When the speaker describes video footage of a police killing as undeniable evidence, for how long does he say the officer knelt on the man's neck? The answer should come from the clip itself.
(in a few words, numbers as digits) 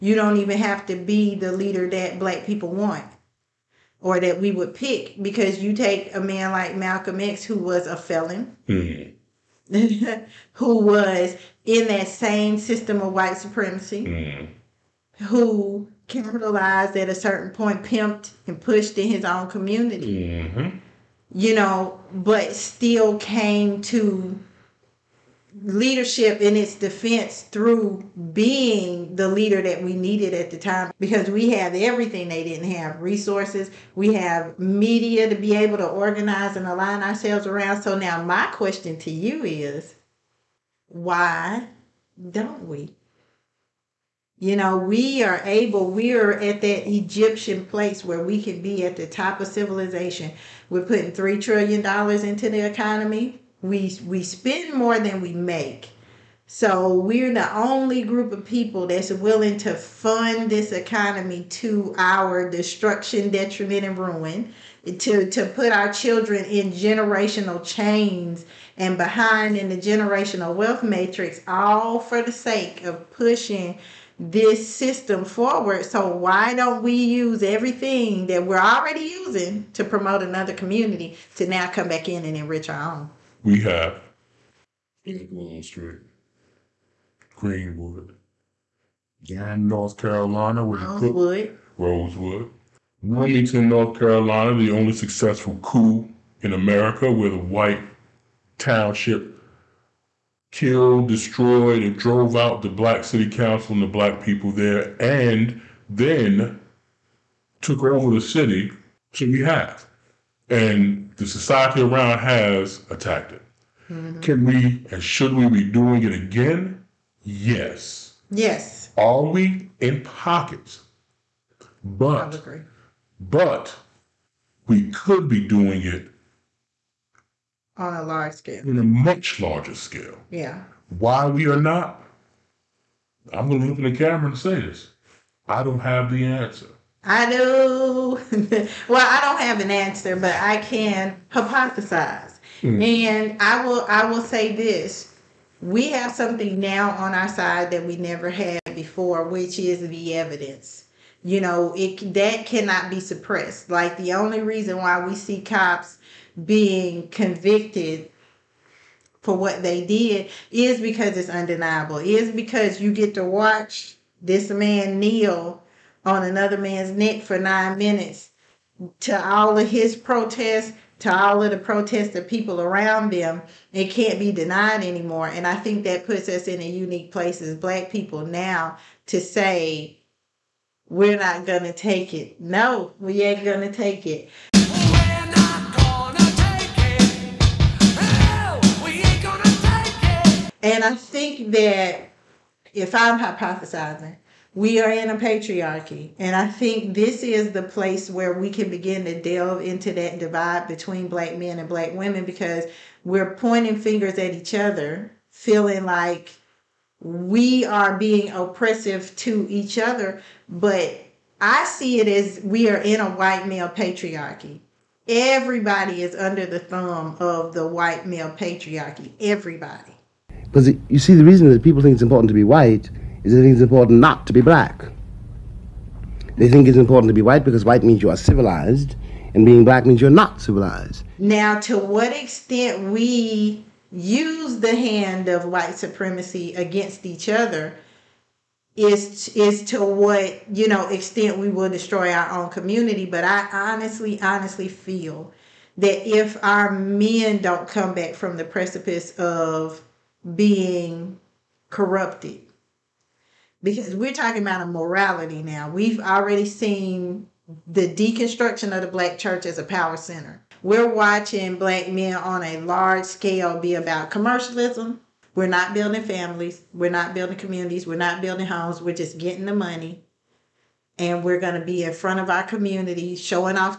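9 minutes.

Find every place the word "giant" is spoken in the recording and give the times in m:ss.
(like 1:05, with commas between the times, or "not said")
not said.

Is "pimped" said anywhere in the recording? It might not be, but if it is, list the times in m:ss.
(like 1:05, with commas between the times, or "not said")
0:17.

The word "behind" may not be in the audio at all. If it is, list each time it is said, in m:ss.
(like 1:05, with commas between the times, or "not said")
1:08.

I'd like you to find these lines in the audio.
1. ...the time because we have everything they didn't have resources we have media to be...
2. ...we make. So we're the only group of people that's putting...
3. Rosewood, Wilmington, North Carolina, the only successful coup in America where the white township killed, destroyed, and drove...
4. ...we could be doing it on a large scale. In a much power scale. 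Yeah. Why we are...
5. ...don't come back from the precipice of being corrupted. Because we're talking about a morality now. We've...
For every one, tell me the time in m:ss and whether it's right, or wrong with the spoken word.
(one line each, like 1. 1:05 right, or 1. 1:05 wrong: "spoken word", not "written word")
1. 0:30 right
2. 0:55 wrong: "willing", not "putting"
3. 1:31 right
4. 2:04 wrong: "larger", not "power"
5. 4:07 right.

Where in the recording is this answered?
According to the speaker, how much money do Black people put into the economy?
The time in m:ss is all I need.
0:51.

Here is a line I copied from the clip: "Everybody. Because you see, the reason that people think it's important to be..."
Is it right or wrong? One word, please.
right.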